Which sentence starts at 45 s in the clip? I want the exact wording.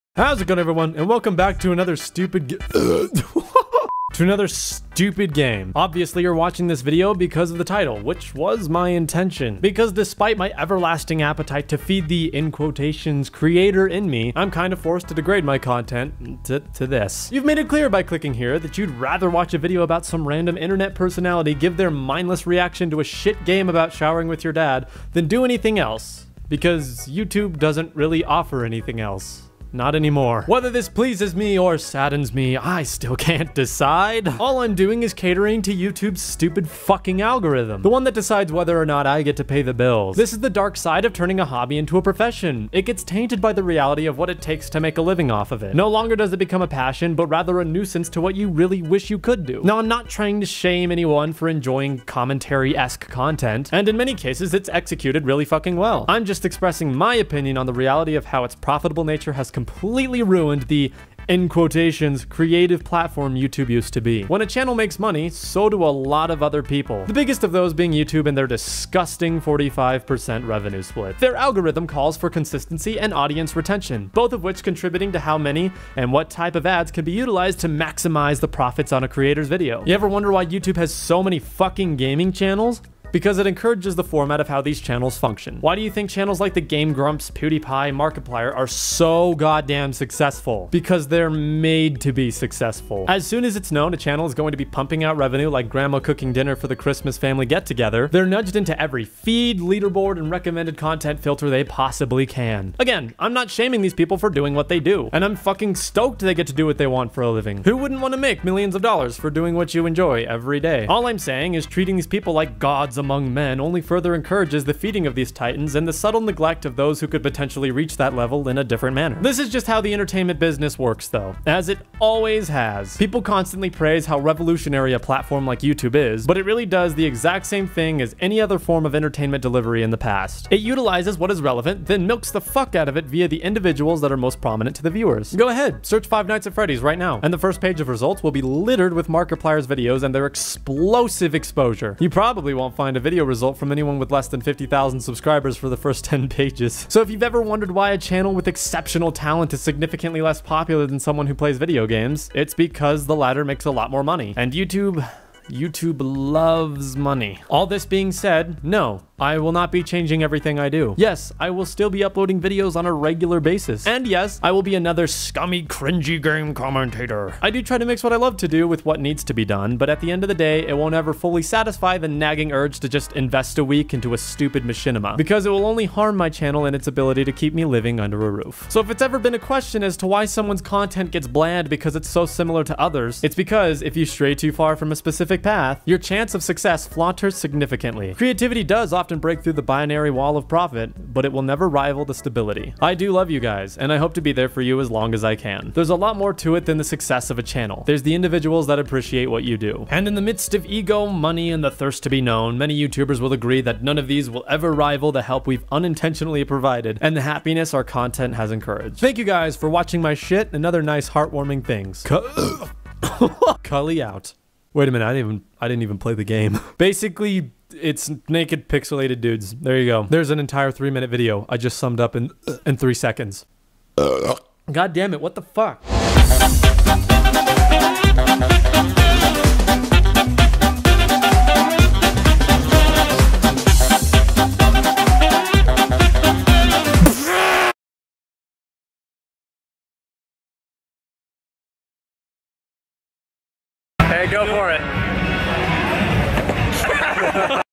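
No longer does it become a passion, but rather a nuisance to what you really wish you could do.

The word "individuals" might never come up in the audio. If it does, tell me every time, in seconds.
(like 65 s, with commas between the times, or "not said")
133 s, 198 s.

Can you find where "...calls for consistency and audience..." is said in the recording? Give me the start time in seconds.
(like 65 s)
71 s.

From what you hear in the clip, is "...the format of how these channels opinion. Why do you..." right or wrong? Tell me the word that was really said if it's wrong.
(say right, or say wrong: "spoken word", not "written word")
wrong: "function", not "opinion".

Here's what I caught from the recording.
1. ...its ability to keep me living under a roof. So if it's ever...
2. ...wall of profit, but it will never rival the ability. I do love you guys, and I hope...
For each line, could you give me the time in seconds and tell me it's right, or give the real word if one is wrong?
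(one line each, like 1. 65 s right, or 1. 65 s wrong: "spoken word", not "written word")
1. 176 s right
2. 190 s wrong: "stability", not "ability".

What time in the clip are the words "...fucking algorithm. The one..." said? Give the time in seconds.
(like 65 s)
36 s.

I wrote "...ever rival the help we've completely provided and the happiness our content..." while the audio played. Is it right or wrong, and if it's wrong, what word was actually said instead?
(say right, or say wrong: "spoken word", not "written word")
wrong: "unintentionally", not "completely".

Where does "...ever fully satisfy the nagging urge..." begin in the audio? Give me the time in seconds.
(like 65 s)
170 s.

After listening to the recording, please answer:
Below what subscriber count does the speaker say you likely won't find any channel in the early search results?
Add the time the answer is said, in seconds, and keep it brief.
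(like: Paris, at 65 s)
50,000, at 144 s.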